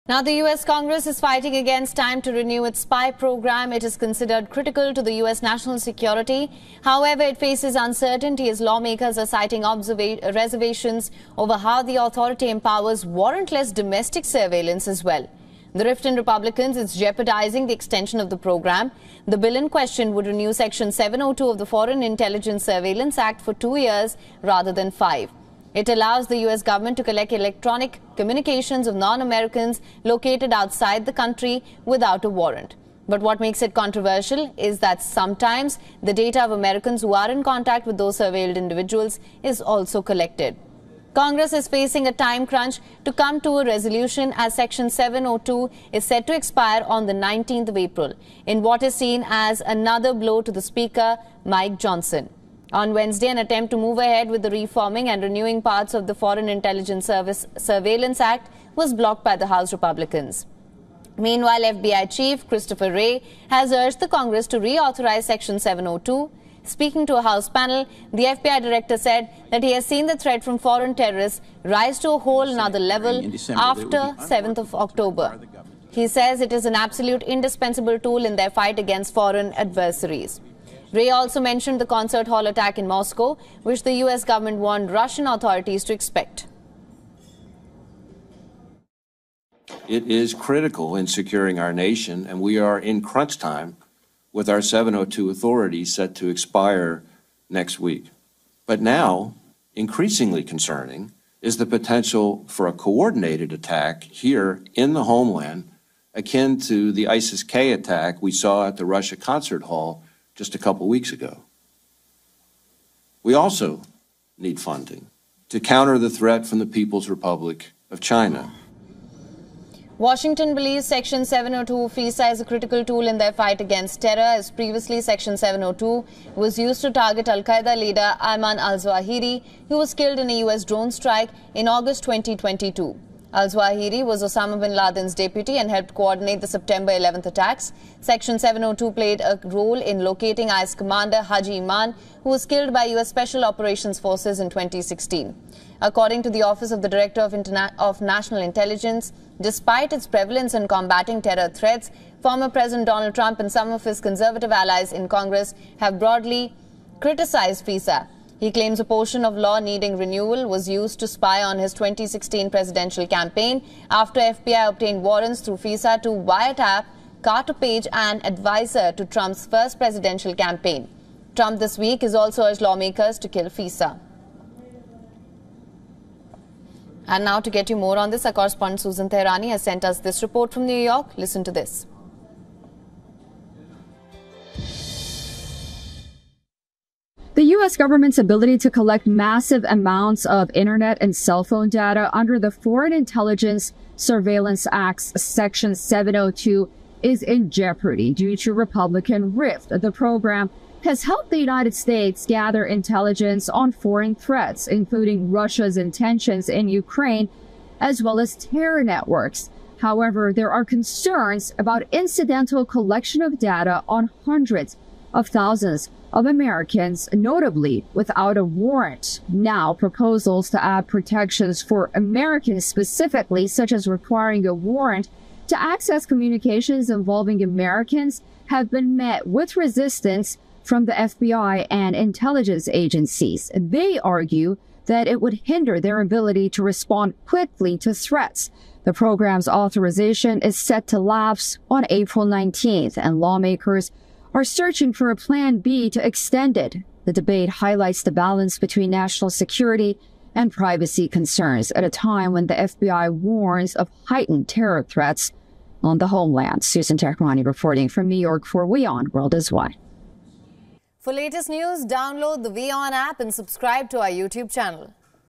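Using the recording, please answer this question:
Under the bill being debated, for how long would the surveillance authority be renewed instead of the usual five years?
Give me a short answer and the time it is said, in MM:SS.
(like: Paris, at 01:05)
2 years, at 00:23.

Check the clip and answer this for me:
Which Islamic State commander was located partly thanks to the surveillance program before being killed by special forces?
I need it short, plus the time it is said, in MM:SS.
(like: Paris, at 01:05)
Haji Iman, at 02:21.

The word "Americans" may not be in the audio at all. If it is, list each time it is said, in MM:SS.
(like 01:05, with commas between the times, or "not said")
00:28, 00:36, 03:36, 03:41, 03:47.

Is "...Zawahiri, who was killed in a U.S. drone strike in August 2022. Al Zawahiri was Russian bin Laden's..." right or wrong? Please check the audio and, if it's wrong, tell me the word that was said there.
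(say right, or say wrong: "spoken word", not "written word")
wrong: "Osama", not "Russian".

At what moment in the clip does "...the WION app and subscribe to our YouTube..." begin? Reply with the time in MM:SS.
04:22.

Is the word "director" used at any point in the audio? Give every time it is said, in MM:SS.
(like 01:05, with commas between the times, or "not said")
01:08, 02:26.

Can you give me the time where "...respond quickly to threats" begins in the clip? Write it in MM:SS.
03:56.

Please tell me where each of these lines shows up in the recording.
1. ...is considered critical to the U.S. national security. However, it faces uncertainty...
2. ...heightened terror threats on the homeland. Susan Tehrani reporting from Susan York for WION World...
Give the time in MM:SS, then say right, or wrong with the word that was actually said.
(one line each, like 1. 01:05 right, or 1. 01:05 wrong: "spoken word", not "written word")
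1. 00:03 right
2. 04:14 wrong: "New", not "Susan".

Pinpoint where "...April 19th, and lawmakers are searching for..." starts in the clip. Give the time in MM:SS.
04:01.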